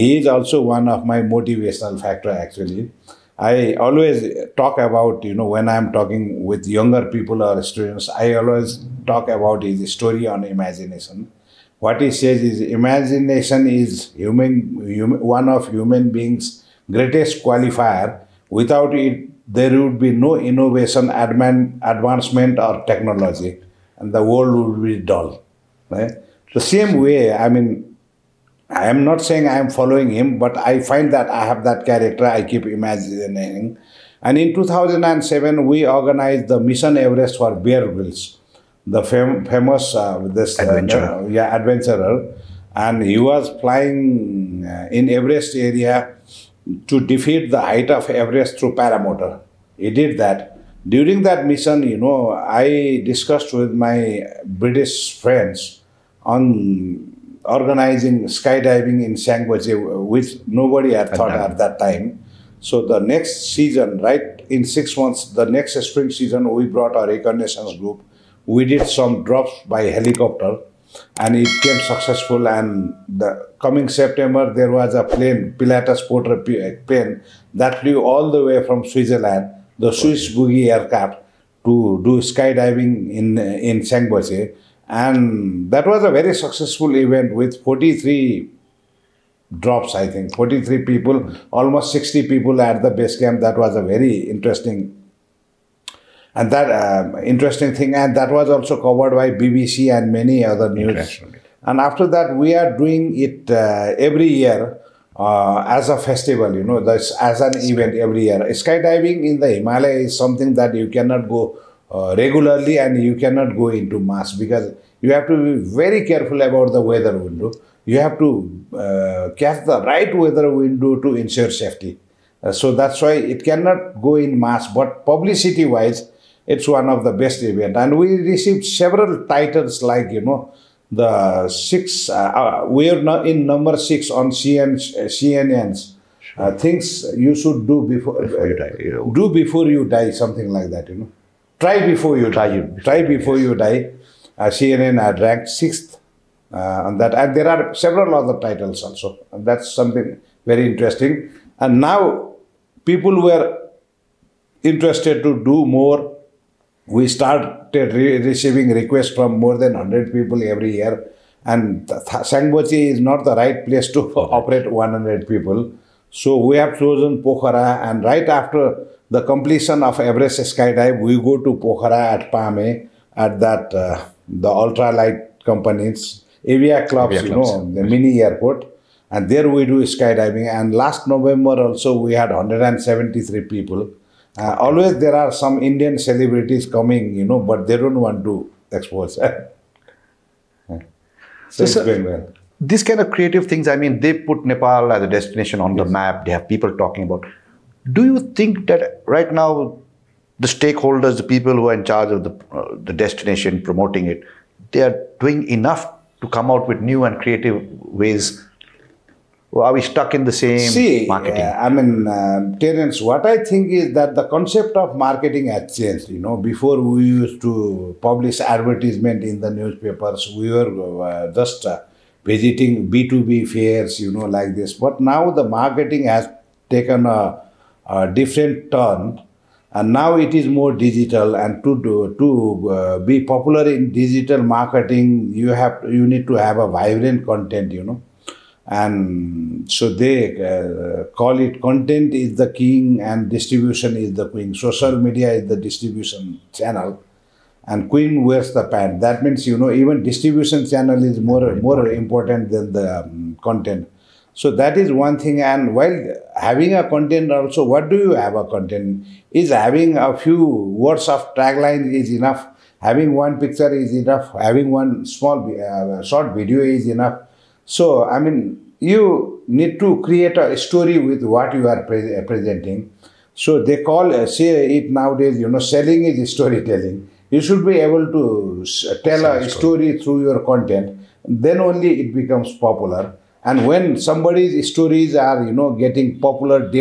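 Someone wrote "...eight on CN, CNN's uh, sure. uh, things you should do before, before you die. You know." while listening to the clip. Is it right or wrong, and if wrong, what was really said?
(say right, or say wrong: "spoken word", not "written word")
wrong: "six", not "eight".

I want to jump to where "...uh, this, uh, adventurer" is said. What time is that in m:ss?
0:39.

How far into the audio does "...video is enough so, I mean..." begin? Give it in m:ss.
4:26.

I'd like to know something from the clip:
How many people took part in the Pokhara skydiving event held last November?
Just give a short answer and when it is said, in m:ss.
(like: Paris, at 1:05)
173, at 3:02.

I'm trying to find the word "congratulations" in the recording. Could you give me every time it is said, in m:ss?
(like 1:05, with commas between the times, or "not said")
not said.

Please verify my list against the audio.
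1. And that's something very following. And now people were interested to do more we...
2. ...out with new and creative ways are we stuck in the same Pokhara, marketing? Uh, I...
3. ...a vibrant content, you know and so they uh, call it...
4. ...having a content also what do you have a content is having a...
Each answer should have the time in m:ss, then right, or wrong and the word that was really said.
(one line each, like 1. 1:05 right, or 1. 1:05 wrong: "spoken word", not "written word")
1. 2:29 wrong: "interesting", not "following"
2. 3:26 wrong: "See", not "Pokhara"
3. 3:56 right
4. 4:16 right.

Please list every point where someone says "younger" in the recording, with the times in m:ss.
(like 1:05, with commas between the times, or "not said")
0:06.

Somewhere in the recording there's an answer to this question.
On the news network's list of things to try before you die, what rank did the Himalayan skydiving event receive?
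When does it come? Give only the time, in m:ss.
2:25.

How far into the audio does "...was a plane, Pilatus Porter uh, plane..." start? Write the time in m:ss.
1:14.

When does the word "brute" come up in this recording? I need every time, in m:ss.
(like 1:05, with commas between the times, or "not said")
not said.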